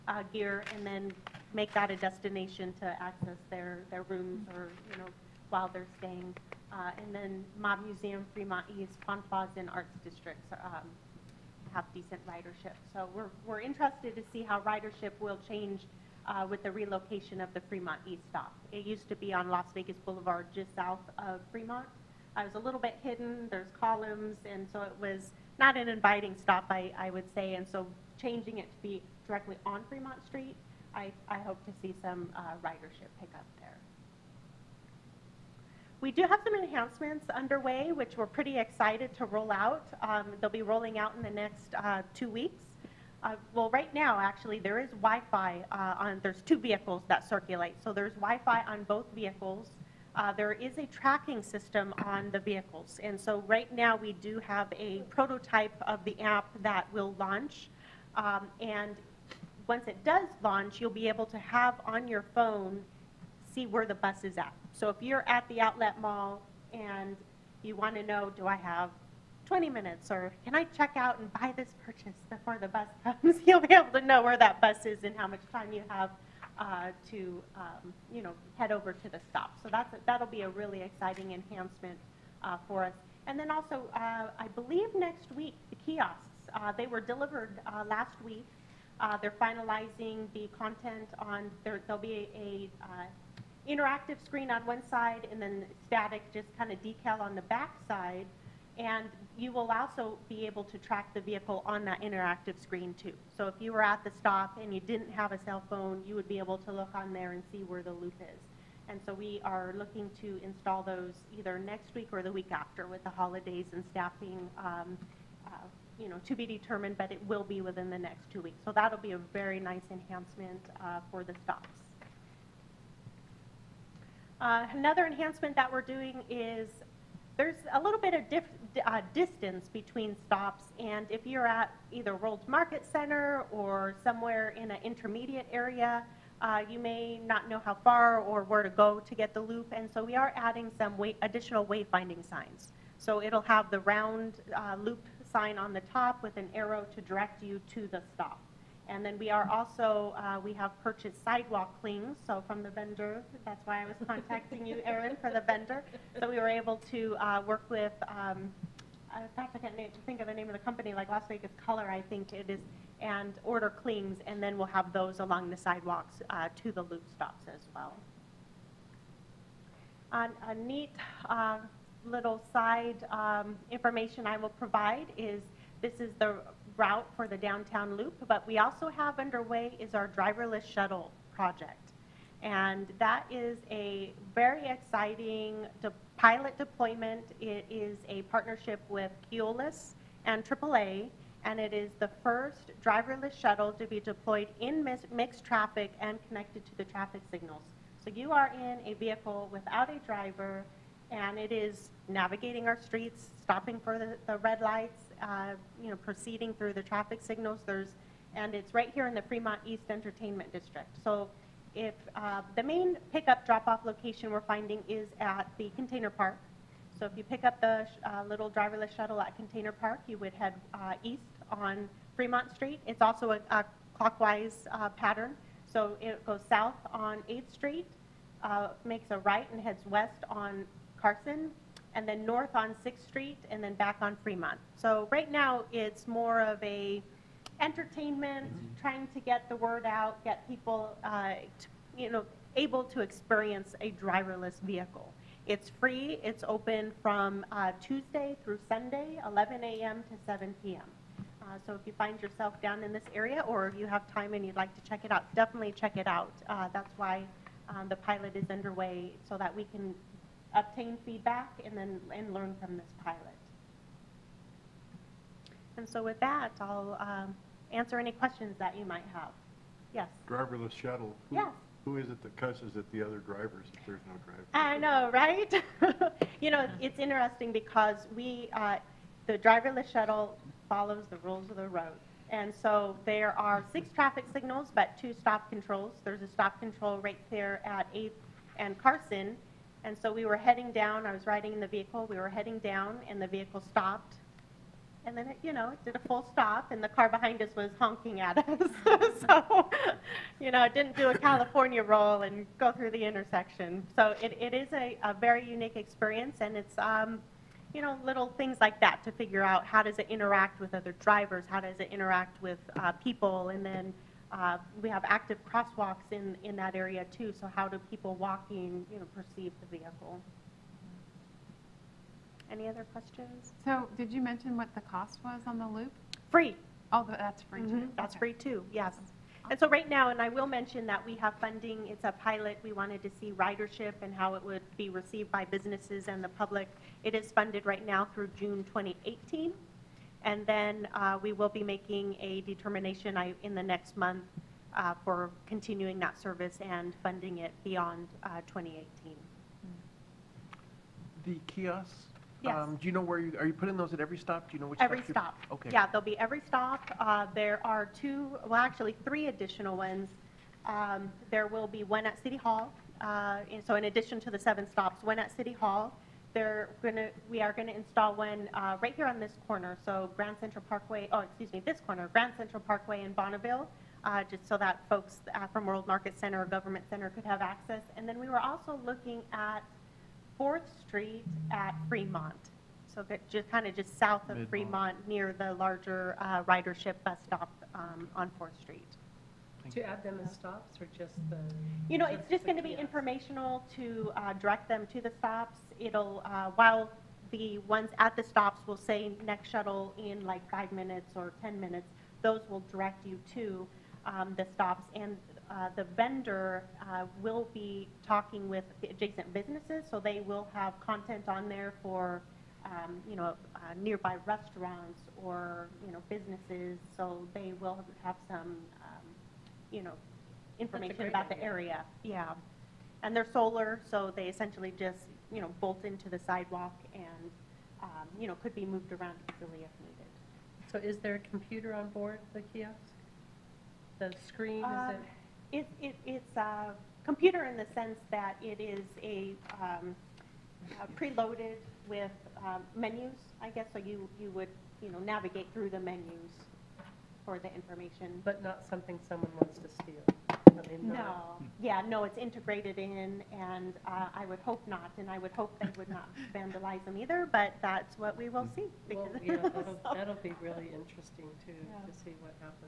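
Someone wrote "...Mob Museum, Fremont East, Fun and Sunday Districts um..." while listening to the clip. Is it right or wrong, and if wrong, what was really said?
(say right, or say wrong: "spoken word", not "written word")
wrong: "Arts", not "Sunday".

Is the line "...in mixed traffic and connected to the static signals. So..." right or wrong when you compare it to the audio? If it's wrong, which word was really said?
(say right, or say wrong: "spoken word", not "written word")
wrong: "traffic", not "static".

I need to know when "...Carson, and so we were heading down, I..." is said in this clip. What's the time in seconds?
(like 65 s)
288 s.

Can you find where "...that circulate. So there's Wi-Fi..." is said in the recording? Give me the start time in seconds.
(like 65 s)
47 s.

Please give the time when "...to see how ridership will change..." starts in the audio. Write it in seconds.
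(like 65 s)
14 s.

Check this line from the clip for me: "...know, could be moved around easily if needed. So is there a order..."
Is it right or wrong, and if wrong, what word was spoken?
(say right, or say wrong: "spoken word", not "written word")
wrong: "computer", not "order".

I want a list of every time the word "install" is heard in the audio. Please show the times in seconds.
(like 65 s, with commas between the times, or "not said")
110 s, 367 s.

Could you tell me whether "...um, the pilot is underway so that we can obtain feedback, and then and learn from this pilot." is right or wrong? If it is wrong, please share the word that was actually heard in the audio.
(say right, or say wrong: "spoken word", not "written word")
right.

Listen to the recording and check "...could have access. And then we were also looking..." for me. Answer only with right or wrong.
right.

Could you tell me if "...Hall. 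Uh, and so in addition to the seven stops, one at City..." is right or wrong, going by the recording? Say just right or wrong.
right.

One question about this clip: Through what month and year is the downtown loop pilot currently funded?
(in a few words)
June 2018.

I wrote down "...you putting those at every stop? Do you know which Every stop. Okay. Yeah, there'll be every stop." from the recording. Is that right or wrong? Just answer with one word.
right.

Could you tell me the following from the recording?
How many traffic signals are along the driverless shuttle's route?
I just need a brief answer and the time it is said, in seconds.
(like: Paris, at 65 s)
6, at 283 s.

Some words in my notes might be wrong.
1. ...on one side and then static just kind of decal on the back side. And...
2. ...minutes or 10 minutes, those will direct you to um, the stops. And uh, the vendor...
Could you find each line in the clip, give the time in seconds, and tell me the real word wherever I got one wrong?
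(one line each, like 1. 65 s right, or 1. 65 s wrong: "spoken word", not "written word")
1. 94 s right
2. 400 s right.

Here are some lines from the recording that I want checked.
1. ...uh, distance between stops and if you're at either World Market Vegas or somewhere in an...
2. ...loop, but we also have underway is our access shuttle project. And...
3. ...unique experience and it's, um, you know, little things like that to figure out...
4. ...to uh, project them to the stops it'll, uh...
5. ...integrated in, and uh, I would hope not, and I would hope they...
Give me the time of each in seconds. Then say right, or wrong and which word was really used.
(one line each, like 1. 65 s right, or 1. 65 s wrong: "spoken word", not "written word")
1. 128 s wrong: "Center", not "Vegas"
2. 177 s wrong: "driverless", not "access"
3. 305 s right
4. 393 s wrong: "direct", not "project"
5. 452 s right.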